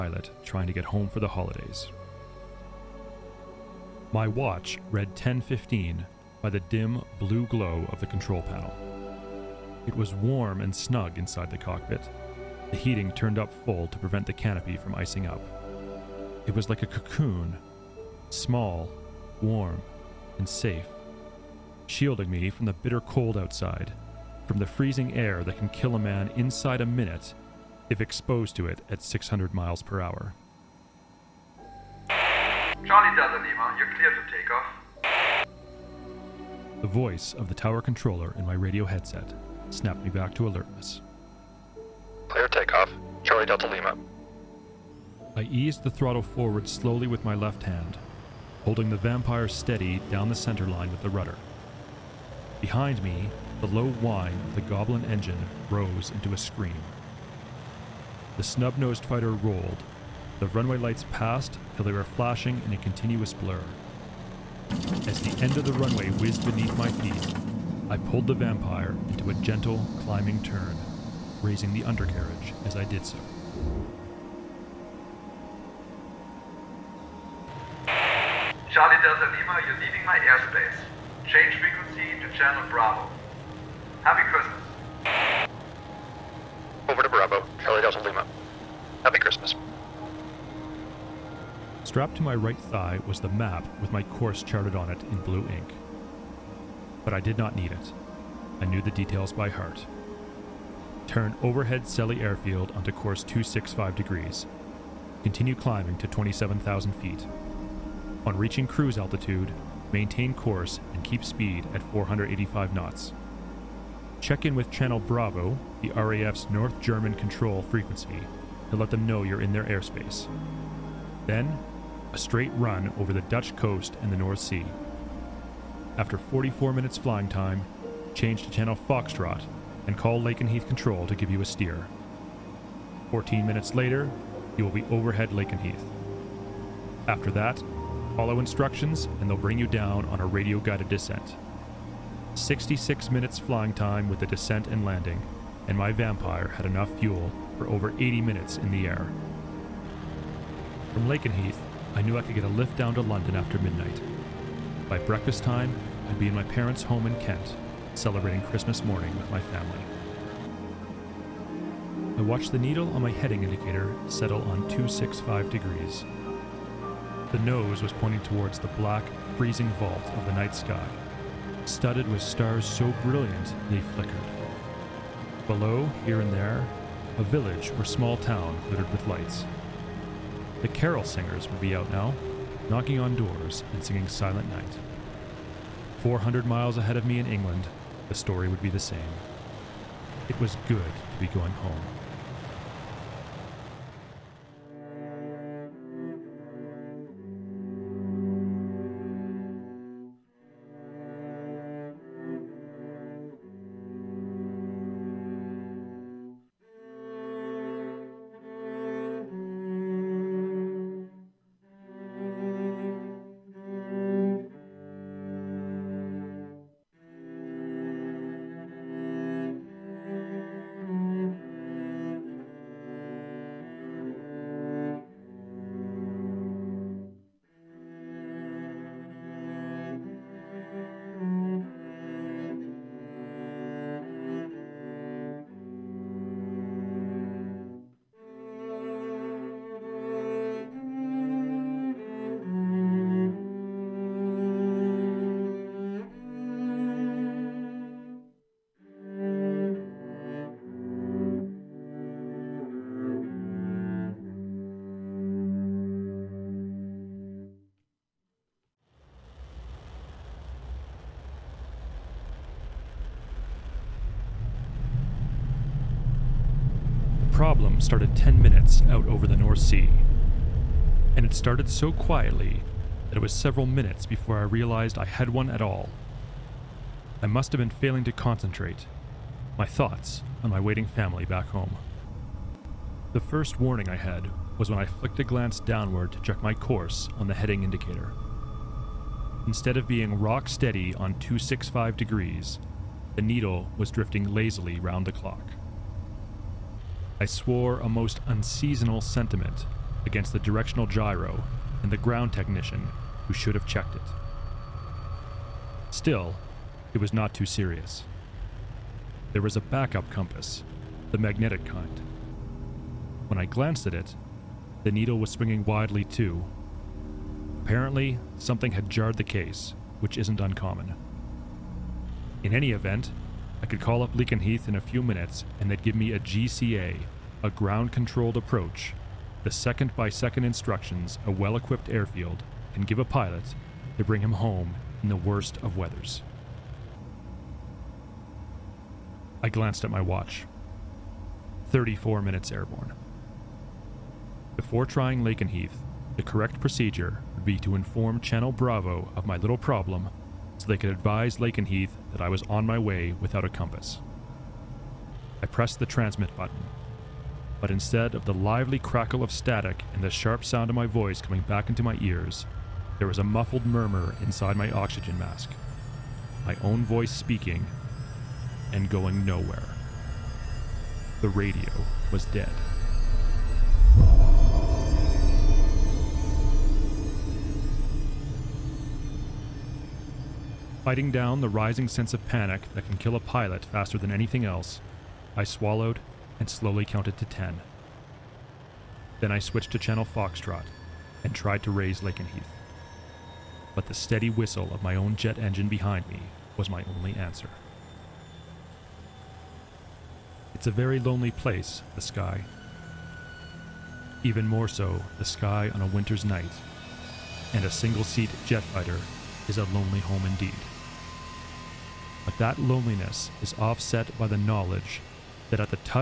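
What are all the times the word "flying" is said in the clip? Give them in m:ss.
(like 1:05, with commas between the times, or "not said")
2:06, 2:23.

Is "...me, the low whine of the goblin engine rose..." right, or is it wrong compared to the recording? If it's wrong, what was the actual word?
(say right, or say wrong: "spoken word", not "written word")
right.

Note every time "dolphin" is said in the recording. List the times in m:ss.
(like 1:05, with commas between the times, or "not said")
not said.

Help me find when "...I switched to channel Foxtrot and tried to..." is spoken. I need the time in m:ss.
6:29.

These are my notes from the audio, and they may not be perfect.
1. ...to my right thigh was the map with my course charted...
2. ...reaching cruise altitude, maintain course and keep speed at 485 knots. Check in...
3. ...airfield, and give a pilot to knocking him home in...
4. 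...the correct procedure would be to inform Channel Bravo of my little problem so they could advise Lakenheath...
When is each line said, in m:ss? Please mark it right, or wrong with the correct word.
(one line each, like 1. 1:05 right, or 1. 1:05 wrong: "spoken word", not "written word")
1. 1:32 right
2. 1:48 right
3. 5:31 wrong: "bring", not "knocking"
4. 5:46 right.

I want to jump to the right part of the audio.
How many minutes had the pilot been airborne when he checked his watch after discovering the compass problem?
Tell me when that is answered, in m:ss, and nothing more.
5:41.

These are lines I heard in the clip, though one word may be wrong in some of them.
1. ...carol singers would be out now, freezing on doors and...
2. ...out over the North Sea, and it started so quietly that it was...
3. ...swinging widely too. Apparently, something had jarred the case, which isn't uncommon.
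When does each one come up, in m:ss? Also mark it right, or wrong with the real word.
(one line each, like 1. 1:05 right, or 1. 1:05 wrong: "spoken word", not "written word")
1. 3:00 wrong: "knocking", not "freezing"
2. 4:28 right
3. 5:15 right.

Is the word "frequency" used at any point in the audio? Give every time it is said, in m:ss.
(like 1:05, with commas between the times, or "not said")
1:21, 1:57.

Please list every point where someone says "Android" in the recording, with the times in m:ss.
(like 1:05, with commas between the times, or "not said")
not said.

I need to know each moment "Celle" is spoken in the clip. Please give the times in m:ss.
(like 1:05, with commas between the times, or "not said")
1:41.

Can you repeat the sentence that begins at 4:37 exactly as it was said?
I must have been failing to concentrate, my thoughts on my waiting family back home.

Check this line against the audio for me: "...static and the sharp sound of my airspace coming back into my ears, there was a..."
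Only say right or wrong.
wrong.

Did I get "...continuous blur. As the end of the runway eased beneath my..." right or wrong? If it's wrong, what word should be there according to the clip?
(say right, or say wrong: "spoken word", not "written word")
wrong: "whizzed", not "eased".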